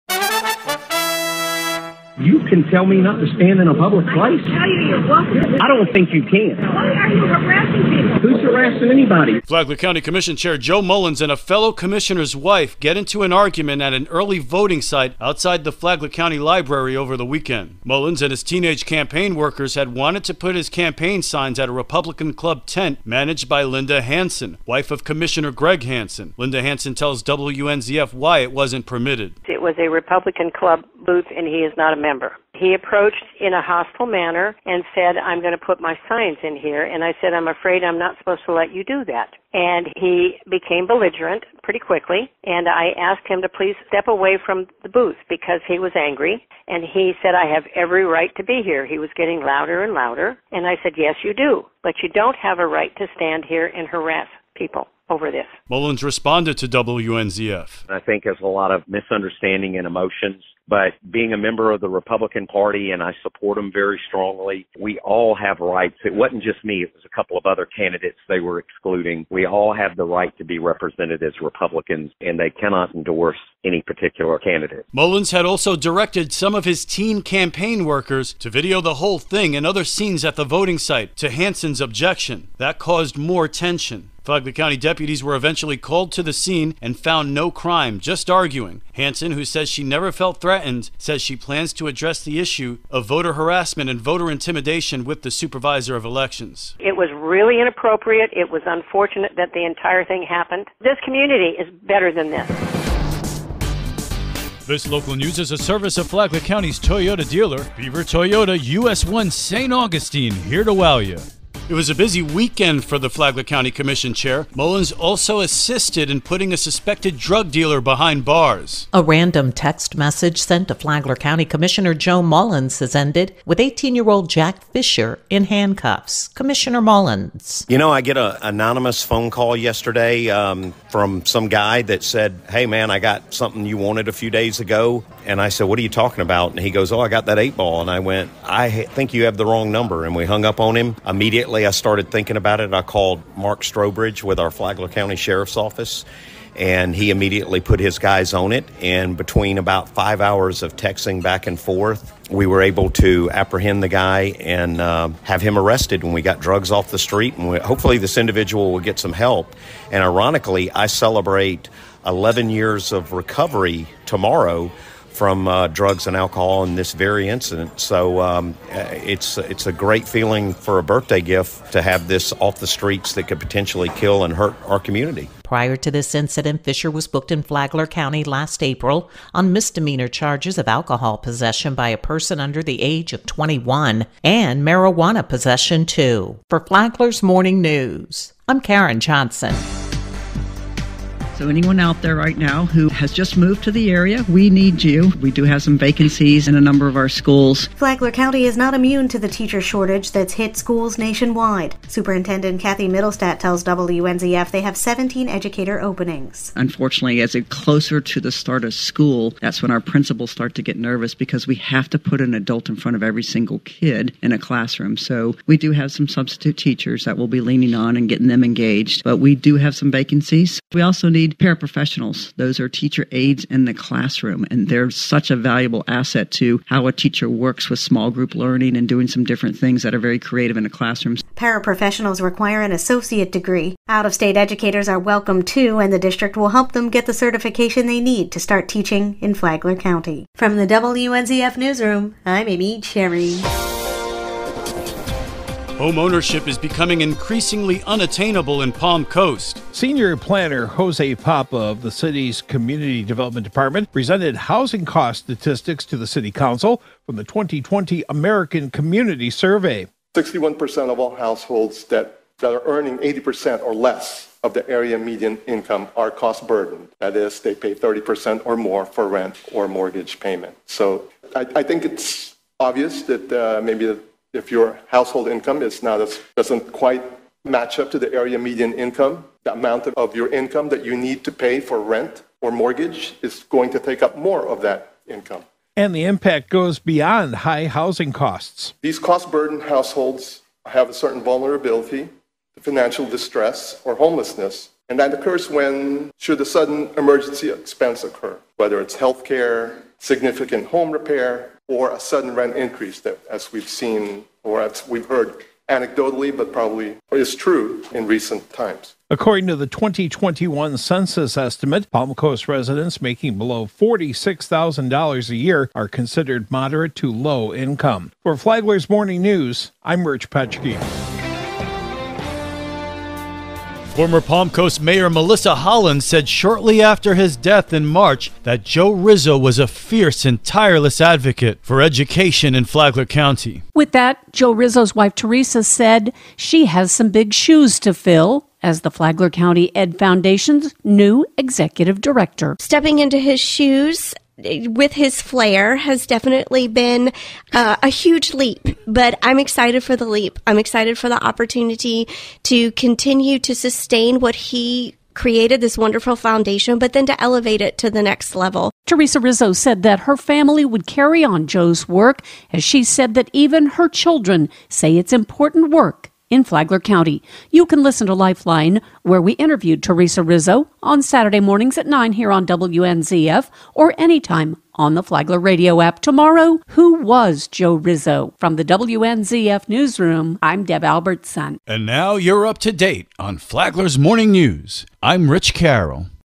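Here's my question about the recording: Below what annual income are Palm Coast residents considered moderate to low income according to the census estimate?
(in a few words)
$46,000.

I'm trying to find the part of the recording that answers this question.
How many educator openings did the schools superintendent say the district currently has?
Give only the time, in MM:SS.
03:24.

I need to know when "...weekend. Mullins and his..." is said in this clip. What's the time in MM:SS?
00:17.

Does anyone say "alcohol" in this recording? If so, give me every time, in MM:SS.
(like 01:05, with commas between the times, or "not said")
02:46, 03:00.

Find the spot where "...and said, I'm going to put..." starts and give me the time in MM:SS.
00:34.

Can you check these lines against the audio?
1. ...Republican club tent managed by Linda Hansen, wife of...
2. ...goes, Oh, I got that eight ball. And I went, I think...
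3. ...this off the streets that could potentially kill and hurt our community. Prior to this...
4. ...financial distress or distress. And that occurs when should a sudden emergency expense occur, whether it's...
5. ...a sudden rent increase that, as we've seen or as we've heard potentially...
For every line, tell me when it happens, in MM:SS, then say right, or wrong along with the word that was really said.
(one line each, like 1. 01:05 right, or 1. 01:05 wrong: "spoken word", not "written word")
1. 00:21 right
2. 02:16 right
3. 02:52 right
4. 04:52 wrong: "homelessness", not "distress"
5. 05:01 wrong: "anecdotally", not "potentially".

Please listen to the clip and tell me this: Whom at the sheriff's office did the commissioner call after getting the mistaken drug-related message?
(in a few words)
Mark Strobridge.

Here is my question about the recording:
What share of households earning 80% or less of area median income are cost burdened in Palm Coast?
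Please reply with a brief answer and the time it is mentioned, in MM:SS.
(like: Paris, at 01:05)
61%, at 04:20.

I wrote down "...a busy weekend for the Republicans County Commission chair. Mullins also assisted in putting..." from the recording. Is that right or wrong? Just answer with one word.
wrong.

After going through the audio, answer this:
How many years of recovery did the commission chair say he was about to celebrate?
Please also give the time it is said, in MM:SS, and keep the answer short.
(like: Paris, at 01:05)
11, at 02:42.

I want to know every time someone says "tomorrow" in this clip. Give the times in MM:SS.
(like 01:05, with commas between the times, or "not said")
02:44, 06:15.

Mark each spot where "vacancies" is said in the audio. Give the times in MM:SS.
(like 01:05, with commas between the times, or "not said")
03:15, 03:39.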